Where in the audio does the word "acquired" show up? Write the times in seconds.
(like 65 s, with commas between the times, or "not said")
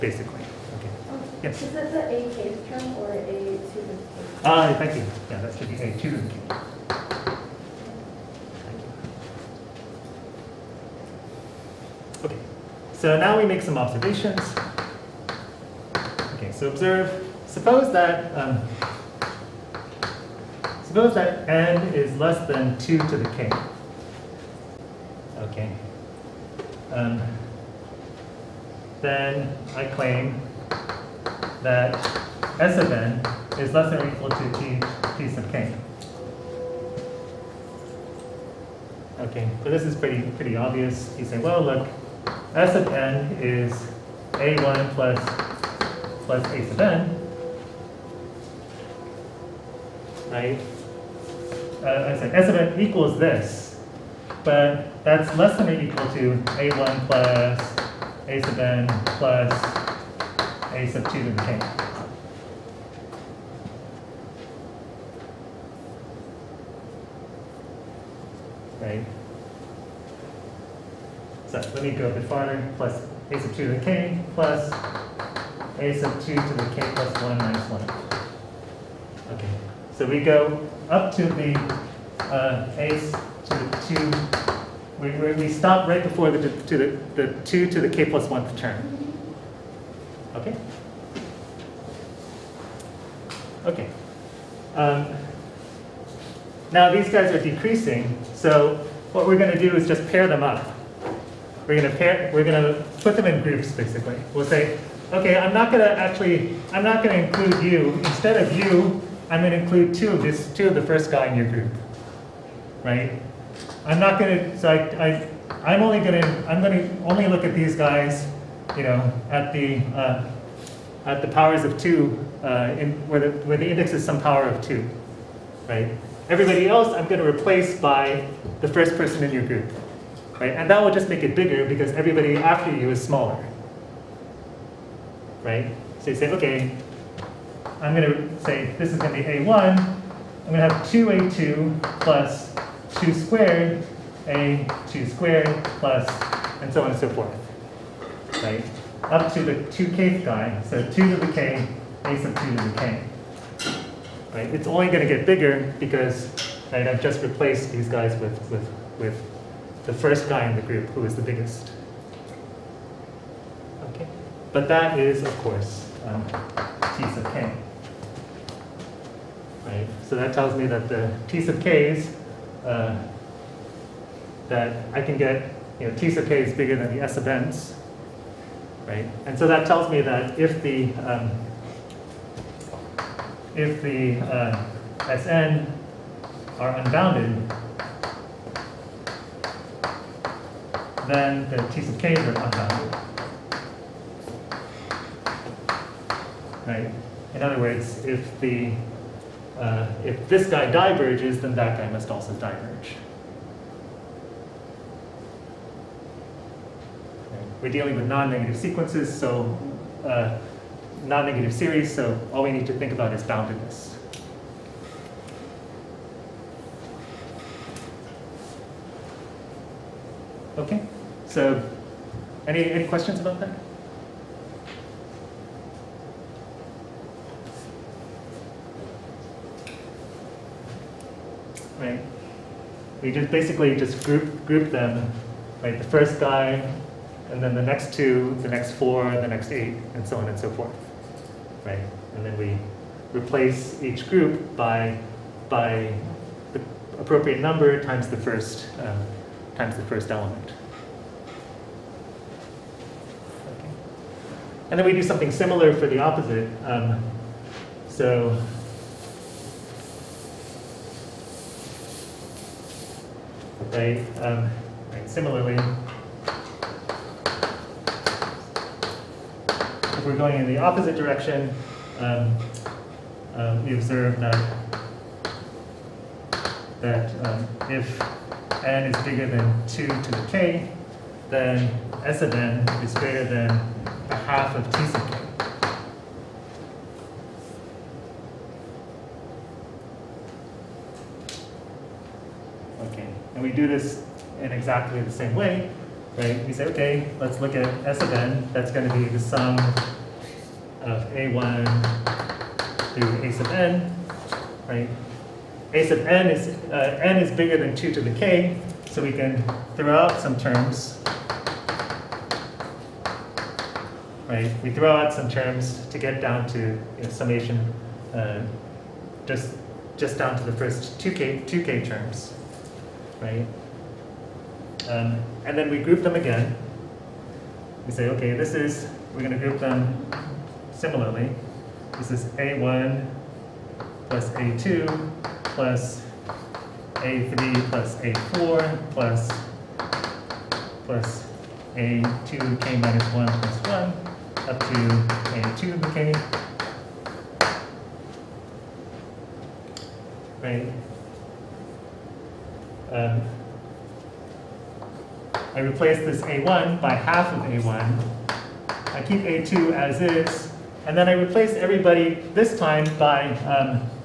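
not said.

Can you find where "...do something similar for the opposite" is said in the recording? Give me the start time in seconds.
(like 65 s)
254 s.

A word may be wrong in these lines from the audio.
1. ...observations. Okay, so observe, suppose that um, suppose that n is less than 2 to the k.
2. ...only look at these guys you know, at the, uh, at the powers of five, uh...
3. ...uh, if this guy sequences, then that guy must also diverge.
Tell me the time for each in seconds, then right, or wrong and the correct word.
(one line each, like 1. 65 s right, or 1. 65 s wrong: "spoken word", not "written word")
1. 13 s right
2. 117 s wrong: "two", not "five"
3. 199 s wrong: "diverges", not "sequences".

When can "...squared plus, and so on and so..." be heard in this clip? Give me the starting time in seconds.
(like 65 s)
145 s.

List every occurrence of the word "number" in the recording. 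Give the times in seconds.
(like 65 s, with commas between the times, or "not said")
247 s.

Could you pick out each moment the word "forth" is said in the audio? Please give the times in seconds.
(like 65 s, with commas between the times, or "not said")
147 s, 240 s.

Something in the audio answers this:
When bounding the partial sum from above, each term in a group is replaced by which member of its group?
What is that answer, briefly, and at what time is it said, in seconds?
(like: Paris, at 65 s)
the first person, at 128 s.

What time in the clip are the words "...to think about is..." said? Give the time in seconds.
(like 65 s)
212 s.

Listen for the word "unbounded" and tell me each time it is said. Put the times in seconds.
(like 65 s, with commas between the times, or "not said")
186 s, 192 s.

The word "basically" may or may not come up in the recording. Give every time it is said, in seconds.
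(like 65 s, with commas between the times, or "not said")
103 s, 233 s.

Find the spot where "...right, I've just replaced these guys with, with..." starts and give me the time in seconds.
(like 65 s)
156 s.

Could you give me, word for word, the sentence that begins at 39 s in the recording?
Okay, so this is pretty pretty obvious.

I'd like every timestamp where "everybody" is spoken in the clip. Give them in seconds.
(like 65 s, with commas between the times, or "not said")
126 s, 131 s, 361 s.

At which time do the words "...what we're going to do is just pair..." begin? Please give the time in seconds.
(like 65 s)
99 s.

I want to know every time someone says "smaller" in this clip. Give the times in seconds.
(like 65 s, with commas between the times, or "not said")
133 s.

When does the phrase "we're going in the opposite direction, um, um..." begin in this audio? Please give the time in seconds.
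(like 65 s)
270 s.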